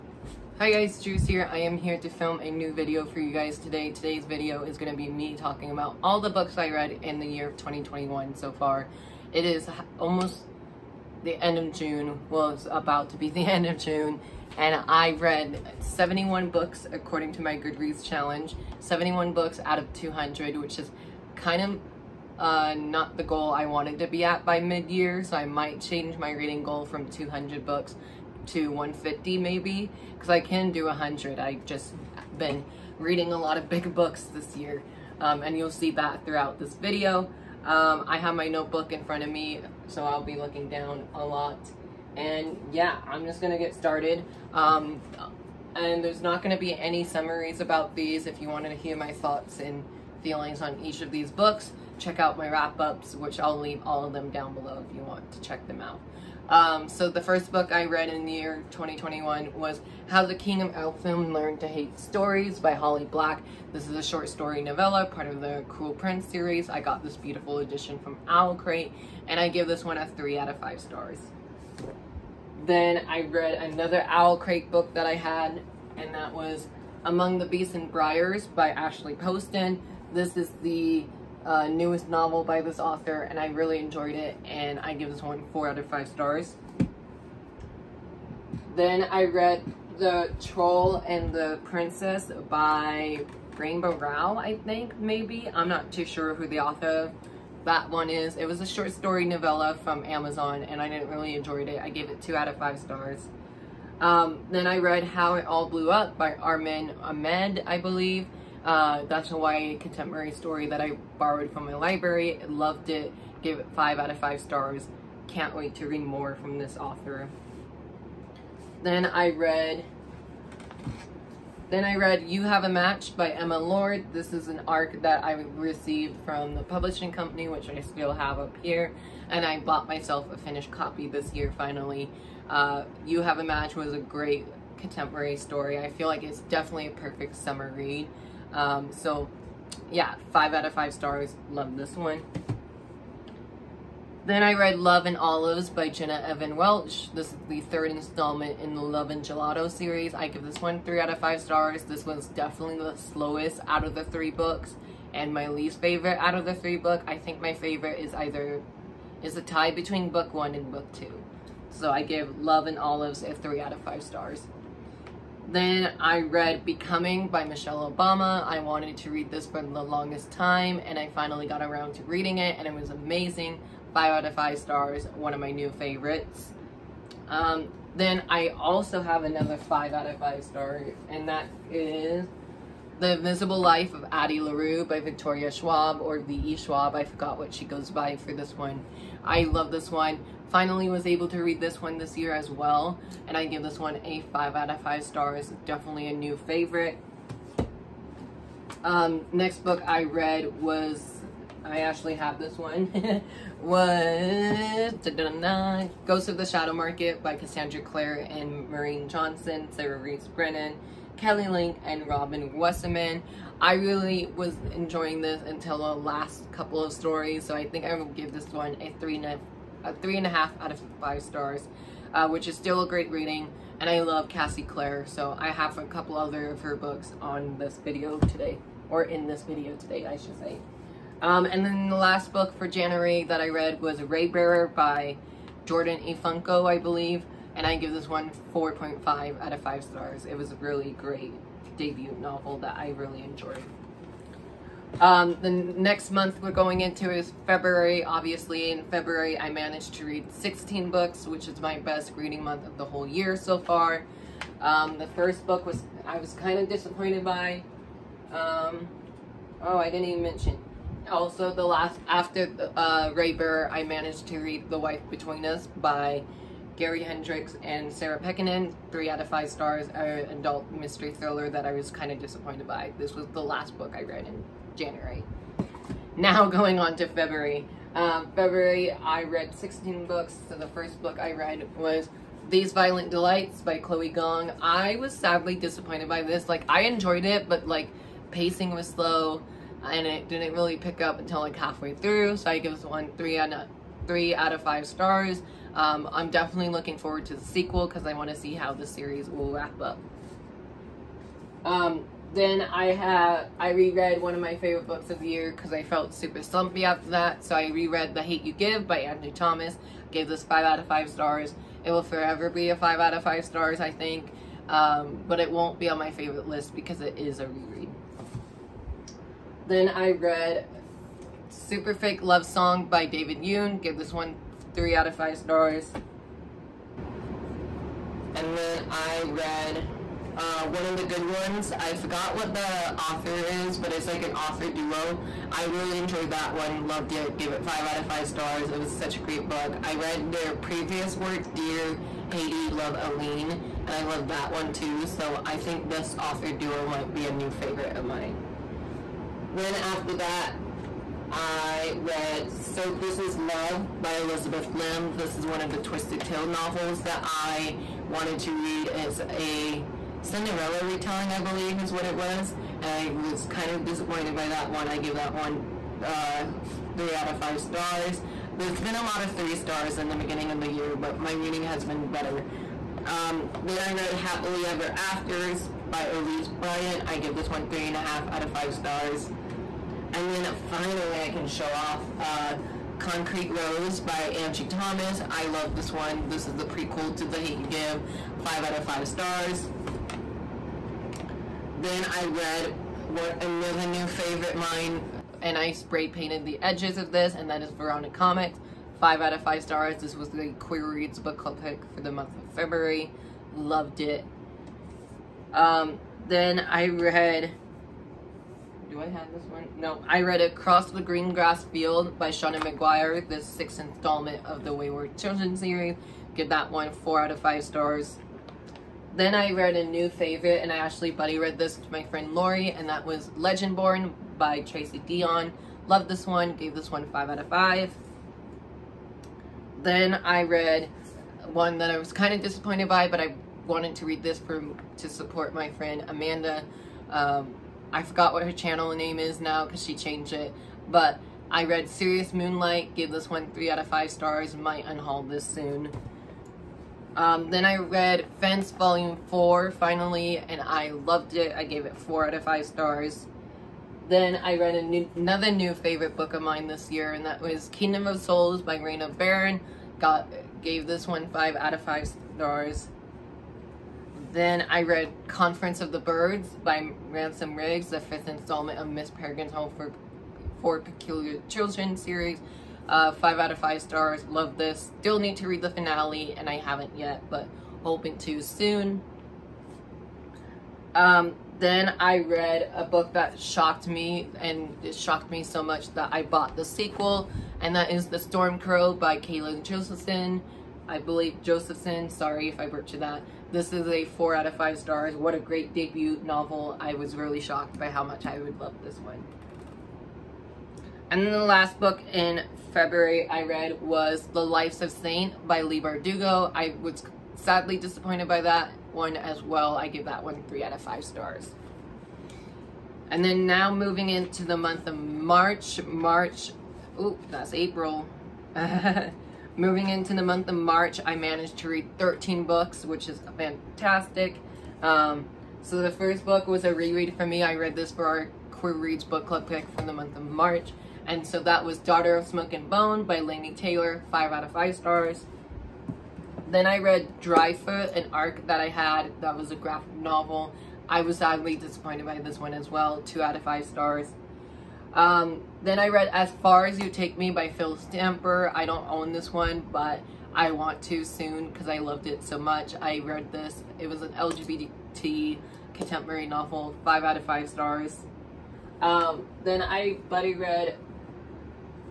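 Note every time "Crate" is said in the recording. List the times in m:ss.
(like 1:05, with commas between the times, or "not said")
1:08, 1:14.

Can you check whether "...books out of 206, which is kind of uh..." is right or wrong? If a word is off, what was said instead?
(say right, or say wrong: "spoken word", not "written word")
wrong: "200", not "206".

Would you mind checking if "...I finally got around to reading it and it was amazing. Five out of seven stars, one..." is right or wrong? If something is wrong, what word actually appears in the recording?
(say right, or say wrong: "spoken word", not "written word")
wrong: "five", not "seven".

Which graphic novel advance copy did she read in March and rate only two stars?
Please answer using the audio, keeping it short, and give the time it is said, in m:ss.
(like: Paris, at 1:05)
Dryfoot, at 8:57.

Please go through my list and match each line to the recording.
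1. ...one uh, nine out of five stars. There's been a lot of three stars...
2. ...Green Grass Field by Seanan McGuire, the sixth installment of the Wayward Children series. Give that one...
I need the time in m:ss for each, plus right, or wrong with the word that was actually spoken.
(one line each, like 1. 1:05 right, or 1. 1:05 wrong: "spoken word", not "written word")
1. 6:05 wrong: "three", not "nine"
2. 6:51 right.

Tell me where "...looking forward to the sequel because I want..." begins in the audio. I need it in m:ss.
4:56.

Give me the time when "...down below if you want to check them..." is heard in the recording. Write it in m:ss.
0:54.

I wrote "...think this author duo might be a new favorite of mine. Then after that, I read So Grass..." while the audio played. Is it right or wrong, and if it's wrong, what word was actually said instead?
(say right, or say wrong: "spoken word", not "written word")
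wrong: "This", not "Grass".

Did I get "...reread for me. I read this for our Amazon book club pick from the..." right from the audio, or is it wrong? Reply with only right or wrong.
wrong.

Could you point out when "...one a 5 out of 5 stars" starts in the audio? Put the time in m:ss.
3:13.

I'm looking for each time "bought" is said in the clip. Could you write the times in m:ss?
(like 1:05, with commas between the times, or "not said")
2:09, 8:06.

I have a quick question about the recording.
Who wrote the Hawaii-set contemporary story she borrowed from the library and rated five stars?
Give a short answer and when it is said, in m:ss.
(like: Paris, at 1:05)
Arvin Ahmadi, at 1:46.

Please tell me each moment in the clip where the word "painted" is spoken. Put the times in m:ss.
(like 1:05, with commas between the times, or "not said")
6:36.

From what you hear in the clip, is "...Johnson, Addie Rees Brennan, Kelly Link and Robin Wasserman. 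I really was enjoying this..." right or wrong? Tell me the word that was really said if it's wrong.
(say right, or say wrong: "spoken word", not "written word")
wrong: "Sarah", not "Addie".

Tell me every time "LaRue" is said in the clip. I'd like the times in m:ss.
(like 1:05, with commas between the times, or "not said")
3:04.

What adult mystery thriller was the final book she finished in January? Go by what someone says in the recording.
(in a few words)
The Wife Between Us.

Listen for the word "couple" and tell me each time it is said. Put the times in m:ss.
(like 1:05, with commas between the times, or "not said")
3:36, 3:45.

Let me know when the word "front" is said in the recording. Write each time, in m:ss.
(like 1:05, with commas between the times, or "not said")
0:39.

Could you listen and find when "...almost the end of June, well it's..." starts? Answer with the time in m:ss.
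0:09.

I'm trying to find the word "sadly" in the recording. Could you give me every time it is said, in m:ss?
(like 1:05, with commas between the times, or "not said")
4:45, 8:27, 9:01.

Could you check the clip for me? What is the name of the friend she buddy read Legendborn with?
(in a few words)
Lori.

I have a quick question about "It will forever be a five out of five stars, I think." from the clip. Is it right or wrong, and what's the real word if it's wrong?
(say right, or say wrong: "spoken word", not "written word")
right.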